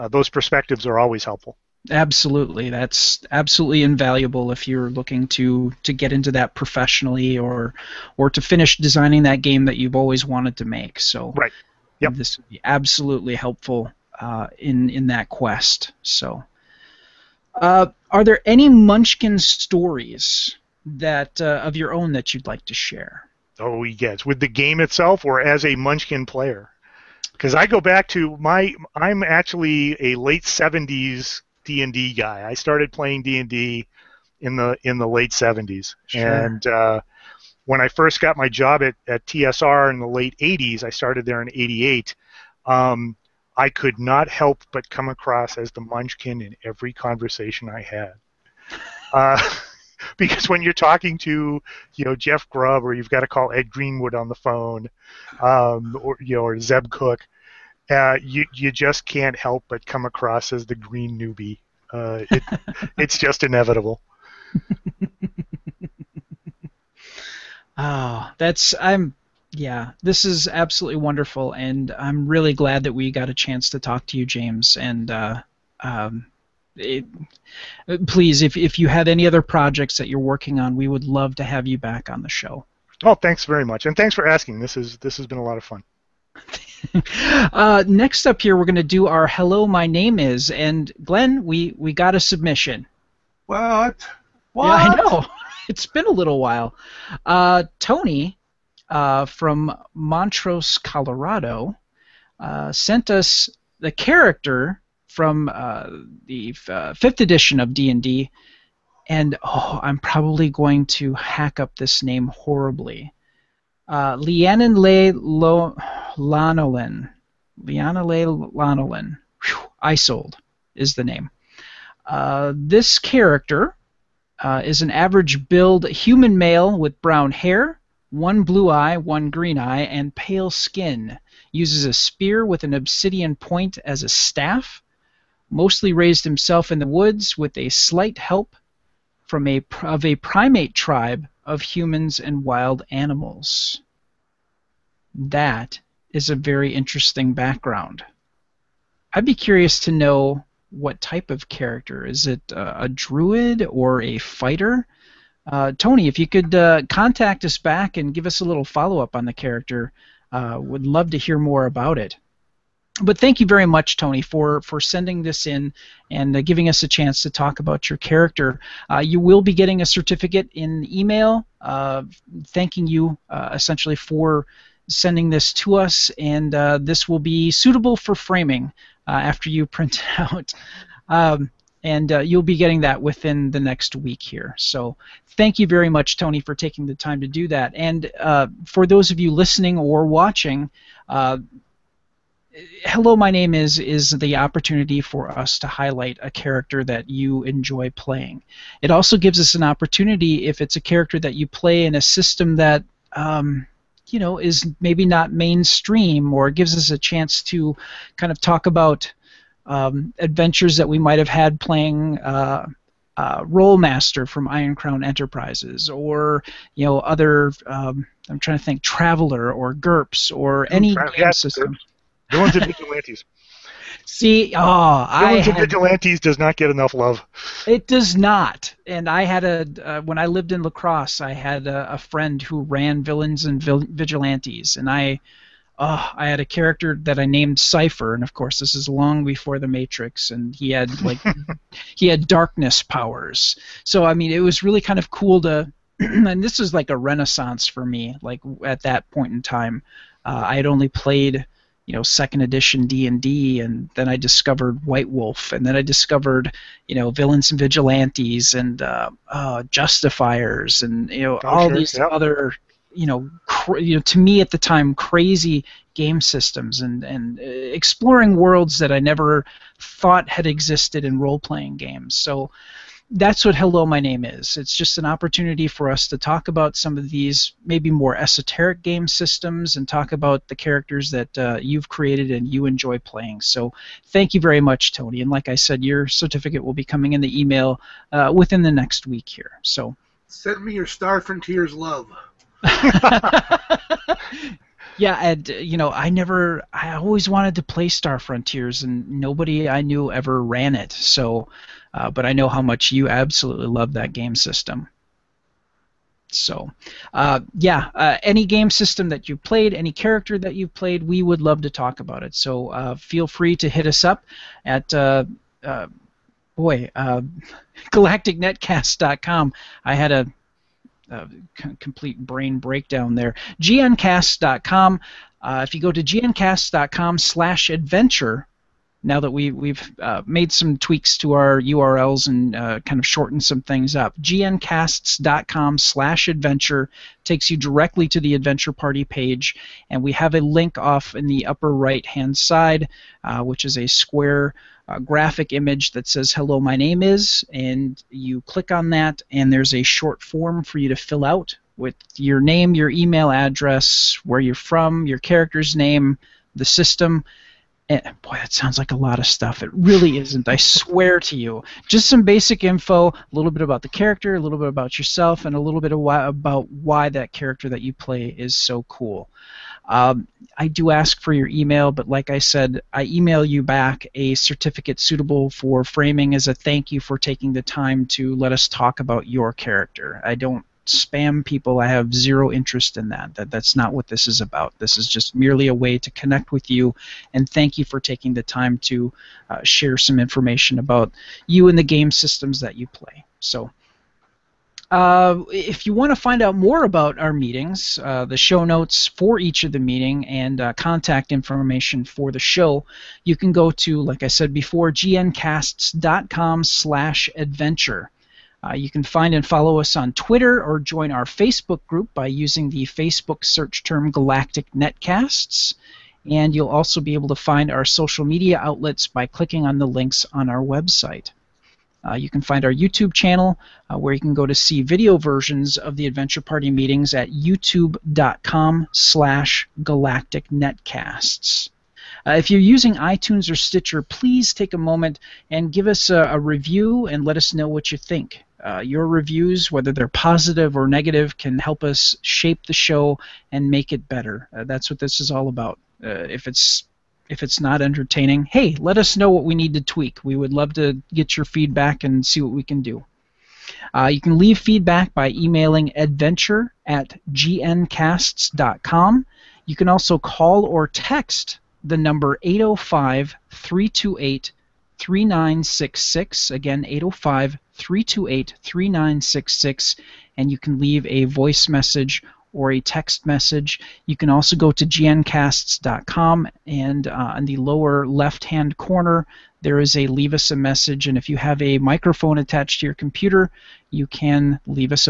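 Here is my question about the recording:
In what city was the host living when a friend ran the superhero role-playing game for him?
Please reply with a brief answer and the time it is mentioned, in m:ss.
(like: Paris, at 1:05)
La Crosse, at 3:50.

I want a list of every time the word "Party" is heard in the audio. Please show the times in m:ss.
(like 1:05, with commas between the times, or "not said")
5:38, 7:06.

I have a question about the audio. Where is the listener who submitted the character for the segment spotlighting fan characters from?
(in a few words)
Montrose, Colorado.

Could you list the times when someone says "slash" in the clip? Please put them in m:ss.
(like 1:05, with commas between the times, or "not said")
5:35, 6:46, 7:08.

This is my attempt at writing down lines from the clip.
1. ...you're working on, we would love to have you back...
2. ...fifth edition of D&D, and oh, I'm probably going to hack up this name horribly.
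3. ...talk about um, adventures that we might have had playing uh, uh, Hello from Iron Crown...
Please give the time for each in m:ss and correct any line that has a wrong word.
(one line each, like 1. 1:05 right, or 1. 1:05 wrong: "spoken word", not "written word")
1. 1:20 right
2. 1:46 right
3. 3:28 wrong: "Rolemaster", not "Hello".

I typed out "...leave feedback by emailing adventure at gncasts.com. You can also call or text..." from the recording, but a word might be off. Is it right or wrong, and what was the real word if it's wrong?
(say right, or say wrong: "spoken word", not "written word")
right.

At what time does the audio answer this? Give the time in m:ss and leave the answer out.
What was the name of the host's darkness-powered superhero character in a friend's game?
3:57.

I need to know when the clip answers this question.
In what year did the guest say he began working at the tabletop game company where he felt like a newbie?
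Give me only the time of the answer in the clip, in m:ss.
0:41.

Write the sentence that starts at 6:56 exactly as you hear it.
And you'll also be able to find our social media outlets by clicking on the links on our website.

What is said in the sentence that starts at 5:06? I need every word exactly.
So, uh, yeah, uh, any game system that you played, any character that you played, we would love to talk about it.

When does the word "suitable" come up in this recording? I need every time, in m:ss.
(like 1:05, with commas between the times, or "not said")
2:57, 6:14.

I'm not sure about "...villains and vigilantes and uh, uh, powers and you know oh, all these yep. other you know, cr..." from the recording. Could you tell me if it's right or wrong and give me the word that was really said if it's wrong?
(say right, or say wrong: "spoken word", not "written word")
wrong: "justifiers", not "powers".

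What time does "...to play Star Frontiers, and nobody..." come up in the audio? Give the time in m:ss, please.
4:57.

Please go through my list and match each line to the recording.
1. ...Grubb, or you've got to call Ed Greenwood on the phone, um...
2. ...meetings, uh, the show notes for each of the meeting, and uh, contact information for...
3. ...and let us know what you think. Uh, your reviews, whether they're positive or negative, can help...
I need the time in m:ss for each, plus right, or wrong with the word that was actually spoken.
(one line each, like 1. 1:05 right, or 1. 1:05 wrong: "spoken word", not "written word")
1. 0:52 right
2. 6:37 right
3. 7:17 right.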